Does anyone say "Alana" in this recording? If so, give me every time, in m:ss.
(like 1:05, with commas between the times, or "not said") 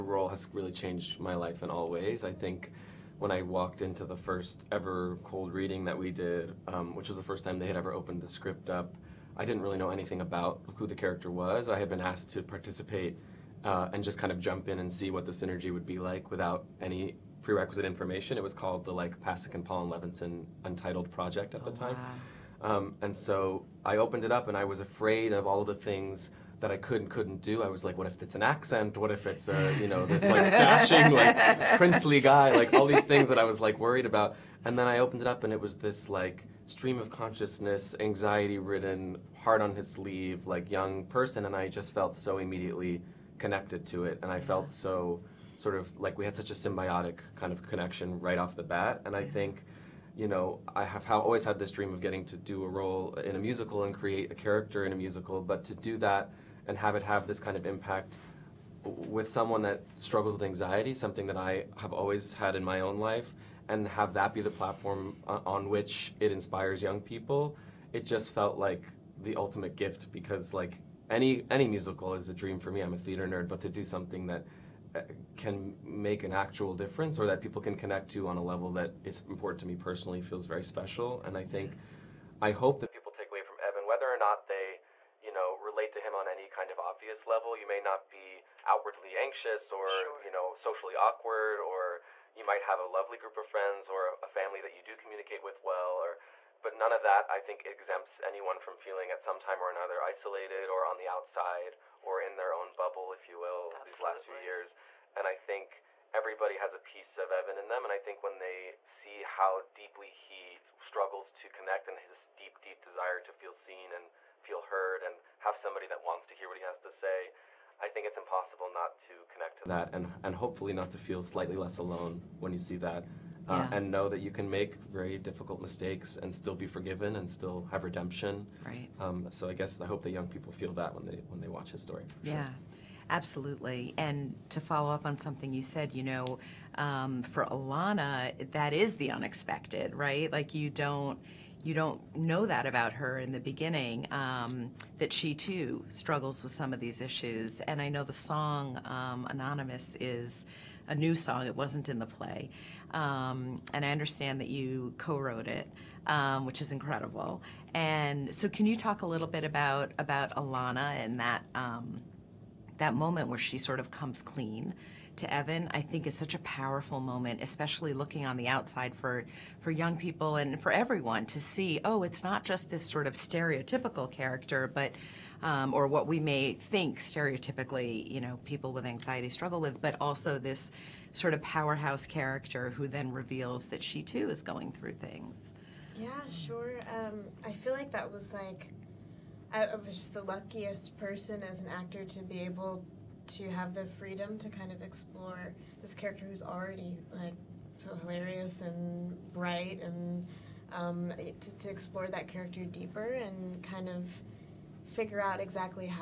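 2:17, 2:40.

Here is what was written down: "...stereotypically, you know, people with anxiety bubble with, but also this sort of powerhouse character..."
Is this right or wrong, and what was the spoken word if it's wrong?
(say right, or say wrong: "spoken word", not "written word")
wrong: "struggle", not "bubble".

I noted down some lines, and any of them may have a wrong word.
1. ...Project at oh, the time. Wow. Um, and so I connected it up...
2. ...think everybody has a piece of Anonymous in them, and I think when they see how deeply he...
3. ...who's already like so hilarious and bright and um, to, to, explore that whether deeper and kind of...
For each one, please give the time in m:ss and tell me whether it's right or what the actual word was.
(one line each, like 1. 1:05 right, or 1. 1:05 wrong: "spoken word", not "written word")
1. 0:21 wrong: "opened", not "connected"
2. 1:45 wrong: "Evan", not "Anonymous"
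3. 3:16 wrong: "character", not "whether".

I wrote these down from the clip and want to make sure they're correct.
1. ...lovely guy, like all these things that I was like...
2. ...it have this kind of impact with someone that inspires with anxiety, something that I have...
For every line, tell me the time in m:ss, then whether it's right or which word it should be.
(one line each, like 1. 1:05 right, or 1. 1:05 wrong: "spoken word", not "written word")
1. 0:31 wrong: "princely", not "lovely"
2. 0:56 wrong: "struggles", not "inspires".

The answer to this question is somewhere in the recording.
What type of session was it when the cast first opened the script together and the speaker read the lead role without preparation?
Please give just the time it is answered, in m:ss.
0:05.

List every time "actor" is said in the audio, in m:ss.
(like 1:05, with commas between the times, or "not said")
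3:11.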